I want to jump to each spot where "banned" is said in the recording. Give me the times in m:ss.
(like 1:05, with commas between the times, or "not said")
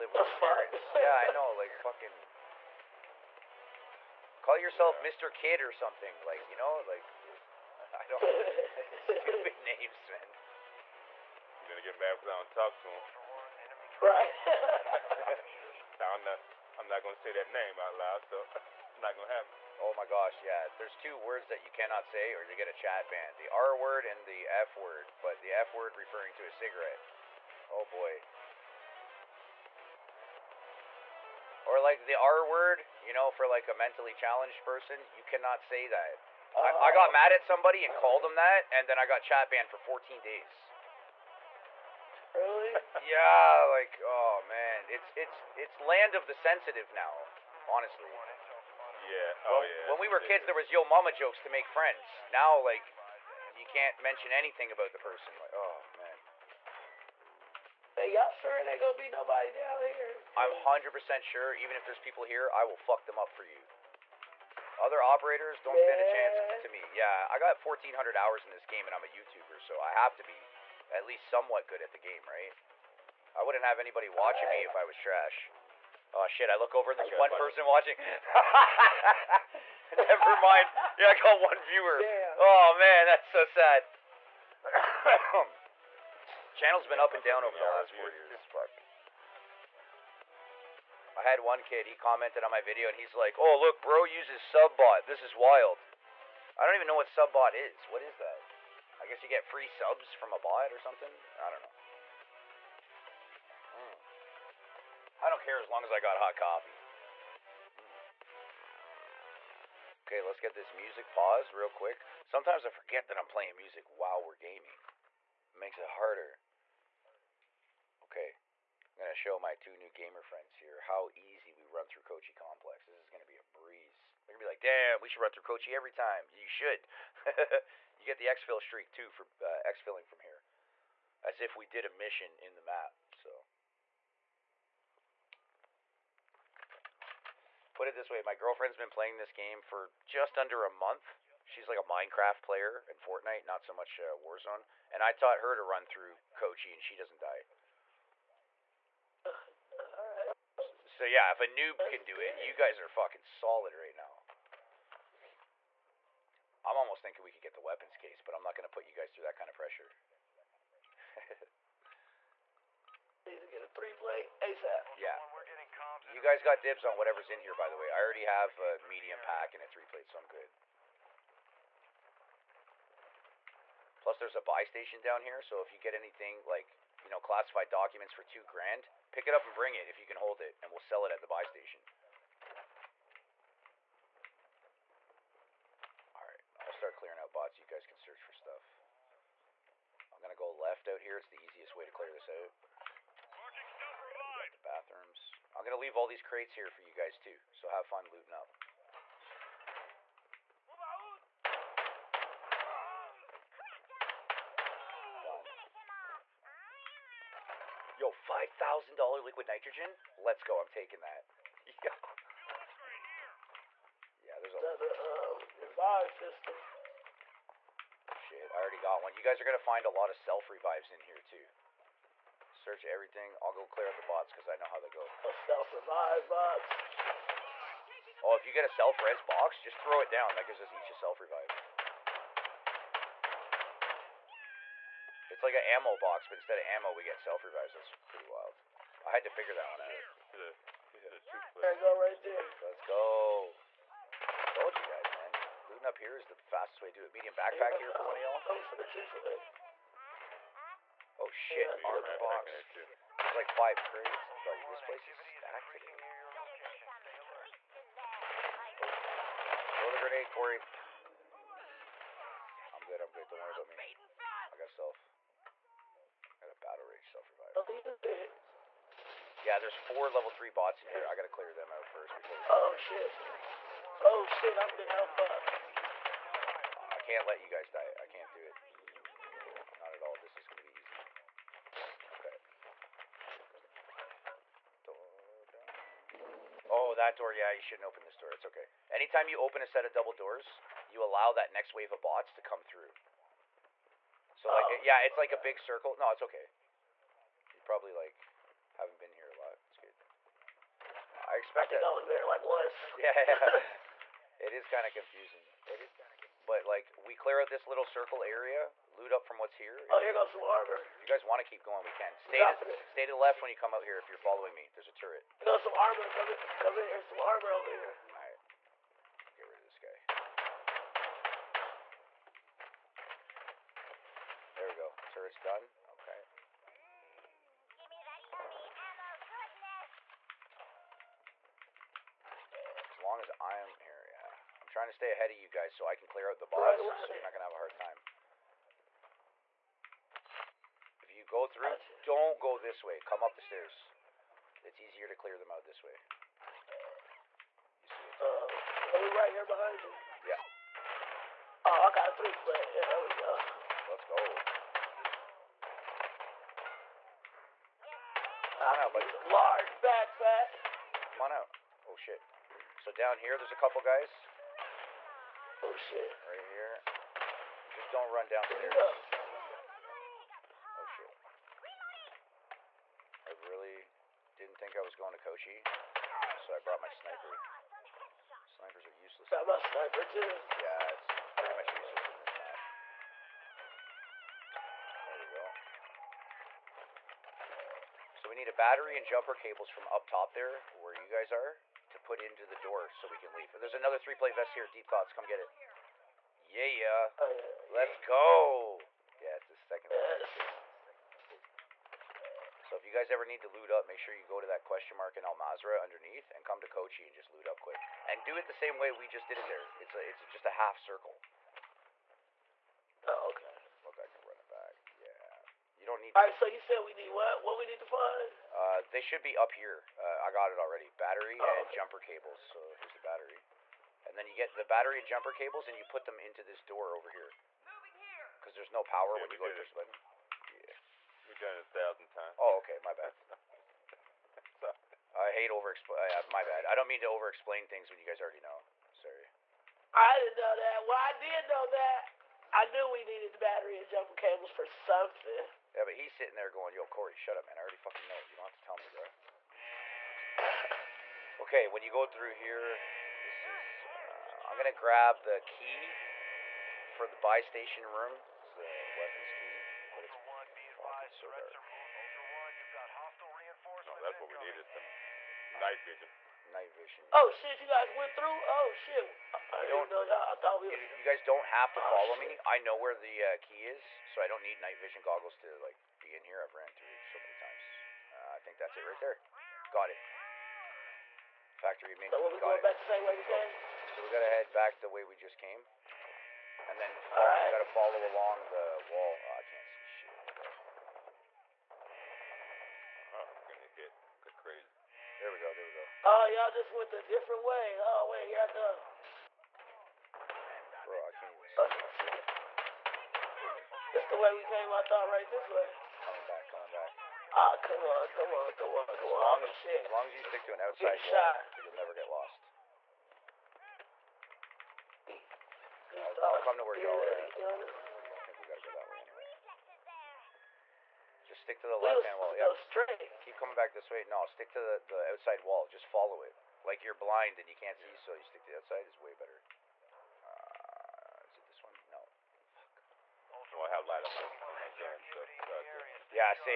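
0:39.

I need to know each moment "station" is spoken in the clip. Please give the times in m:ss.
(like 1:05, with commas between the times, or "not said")
2:54, 3:01, 7:37.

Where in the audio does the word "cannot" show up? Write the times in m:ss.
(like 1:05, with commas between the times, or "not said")
0:21, 0:35.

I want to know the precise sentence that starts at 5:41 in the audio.
If you go through, don't go this way.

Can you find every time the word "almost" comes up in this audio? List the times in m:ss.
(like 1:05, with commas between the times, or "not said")
2:36.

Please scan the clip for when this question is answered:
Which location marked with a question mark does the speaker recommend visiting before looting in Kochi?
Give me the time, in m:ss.
6:45.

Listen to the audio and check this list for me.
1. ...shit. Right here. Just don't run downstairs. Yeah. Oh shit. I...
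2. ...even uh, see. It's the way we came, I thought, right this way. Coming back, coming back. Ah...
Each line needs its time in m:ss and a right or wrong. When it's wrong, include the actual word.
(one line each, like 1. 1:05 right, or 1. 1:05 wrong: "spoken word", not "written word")
1. 6:05 right
2. 8:21 right.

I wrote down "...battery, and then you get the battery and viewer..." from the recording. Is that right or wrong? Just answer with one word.
wrong.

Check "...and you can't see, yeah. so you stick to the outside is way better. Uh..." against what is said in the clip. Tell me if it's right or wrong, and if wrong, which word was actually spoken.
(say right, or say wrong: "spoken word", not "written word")
right.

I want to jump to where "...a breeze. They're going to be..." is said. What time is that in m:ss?
2:03.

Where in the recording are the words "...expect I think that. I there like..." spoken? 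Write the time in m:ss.
5:01.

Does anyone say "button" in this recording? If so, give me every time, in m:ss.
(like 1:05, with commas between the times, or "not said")
7:09.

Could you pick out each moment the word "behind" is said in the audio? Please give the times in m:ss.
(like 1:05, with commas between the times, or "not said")
5:49.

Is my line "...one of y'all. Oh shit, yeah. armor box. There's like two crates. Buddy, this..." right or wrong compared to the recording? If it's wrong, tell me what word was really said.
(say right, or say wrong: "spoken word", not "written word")
wrong: "five", not "two".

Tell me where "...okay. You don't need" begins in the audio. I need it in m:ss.
6:53.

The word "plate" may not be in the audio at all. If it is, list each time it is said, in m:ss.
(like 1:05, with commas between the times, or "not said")
2:49, 6:33.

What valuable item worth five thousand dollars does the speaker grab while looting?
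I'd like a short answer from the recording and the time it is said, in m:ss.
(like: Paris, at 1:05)
liquid nitrogen, at 3:29.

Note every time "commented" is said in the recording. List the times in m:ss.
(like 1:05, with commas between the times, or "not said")
1:31.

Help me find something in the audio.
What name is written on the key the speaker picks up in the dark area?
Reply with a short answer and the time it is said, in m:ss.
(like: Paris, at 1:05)
Factory main, at 8:01.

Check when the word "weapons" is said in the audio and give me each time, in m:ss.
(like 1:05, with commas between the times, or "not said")
2:37, 7:38.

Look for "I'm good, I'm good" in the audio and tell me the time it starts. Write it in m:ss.
4:22.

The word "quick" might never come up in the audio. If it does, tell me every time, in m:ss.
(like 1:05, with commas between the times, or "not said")
1:51, 6:47.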